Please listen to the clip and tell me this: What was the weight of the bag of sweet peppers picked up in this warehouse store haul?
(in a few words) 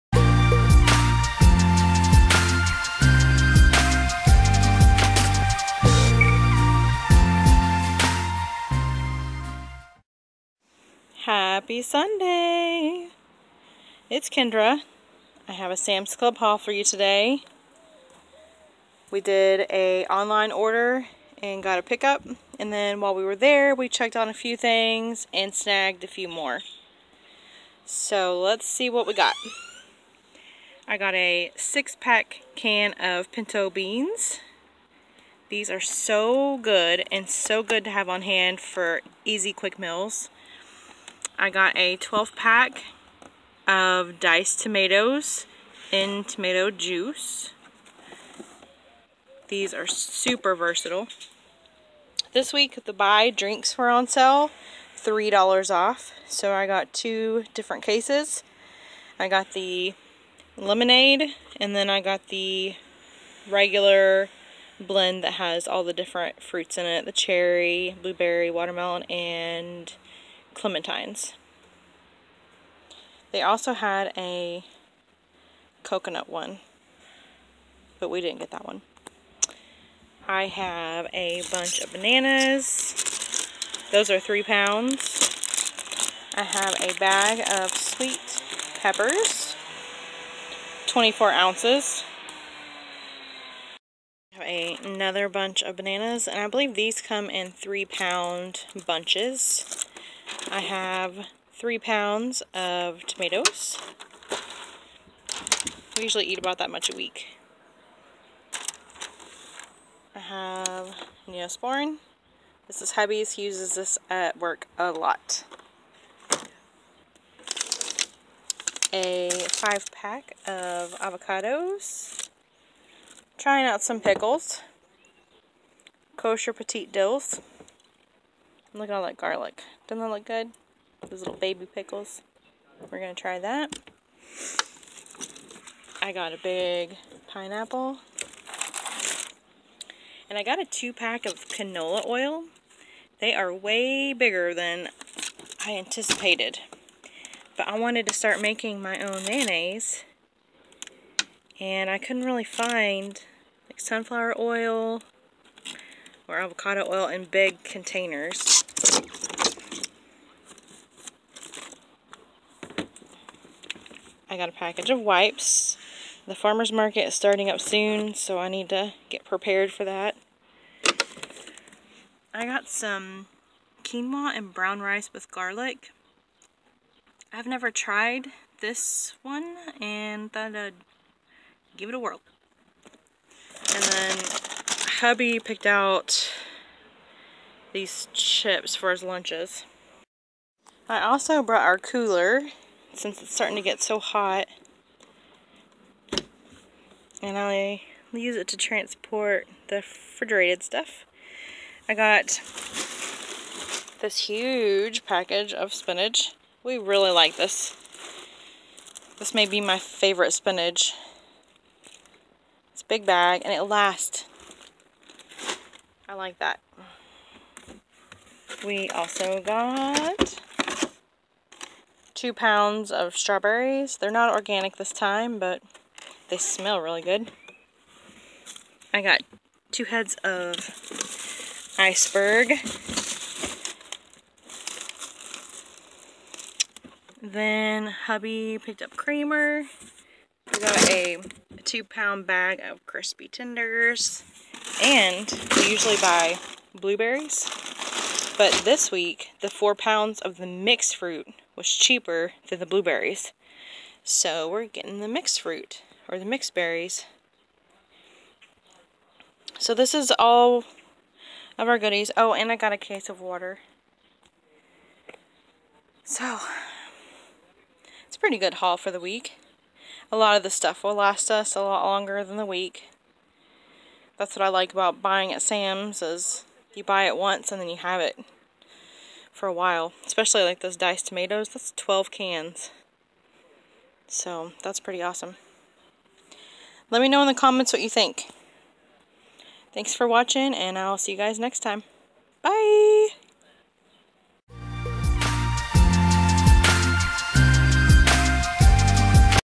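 24 ounces.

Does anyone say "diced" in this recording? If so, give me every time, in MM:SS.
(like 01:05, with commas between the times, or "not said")
00:44, 04:40.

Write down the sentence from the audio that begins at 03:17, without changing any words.
And I use it to transport the refrigerated stuff.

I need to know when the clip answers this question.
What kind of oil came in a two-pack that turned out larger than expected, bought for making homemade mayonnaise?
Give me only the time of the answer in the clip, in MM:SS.
02:21.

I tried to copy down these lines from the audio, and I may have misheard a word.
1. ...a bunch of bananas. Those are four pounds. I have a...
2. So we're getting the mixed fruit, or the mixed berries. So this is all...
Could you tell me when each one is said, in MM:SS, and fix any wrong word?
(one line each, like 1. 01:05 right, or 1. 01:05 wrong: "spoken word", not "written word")
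1. 01:21 wrong: "three", not "four"
2. 04:14 right.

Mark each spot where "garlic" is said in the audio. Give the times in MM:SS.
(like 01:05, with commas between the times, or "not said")
02:09, 02:55.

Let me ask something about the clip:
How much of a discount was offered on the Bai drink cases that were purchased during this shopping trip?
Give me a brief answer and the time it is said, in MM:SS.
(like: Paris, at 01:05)
$3 off, at 00:54.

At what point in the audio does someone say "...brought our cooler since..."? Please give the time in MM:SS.
03:11.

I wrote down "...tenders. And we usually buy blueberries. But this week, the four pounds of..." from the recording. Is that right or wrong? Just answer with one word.
right.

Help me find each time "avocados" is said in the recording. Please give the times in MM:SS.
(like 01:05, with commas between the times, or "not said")
02:00, 02:36.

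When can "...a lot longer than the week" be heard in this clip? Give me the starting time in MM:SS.
04:31.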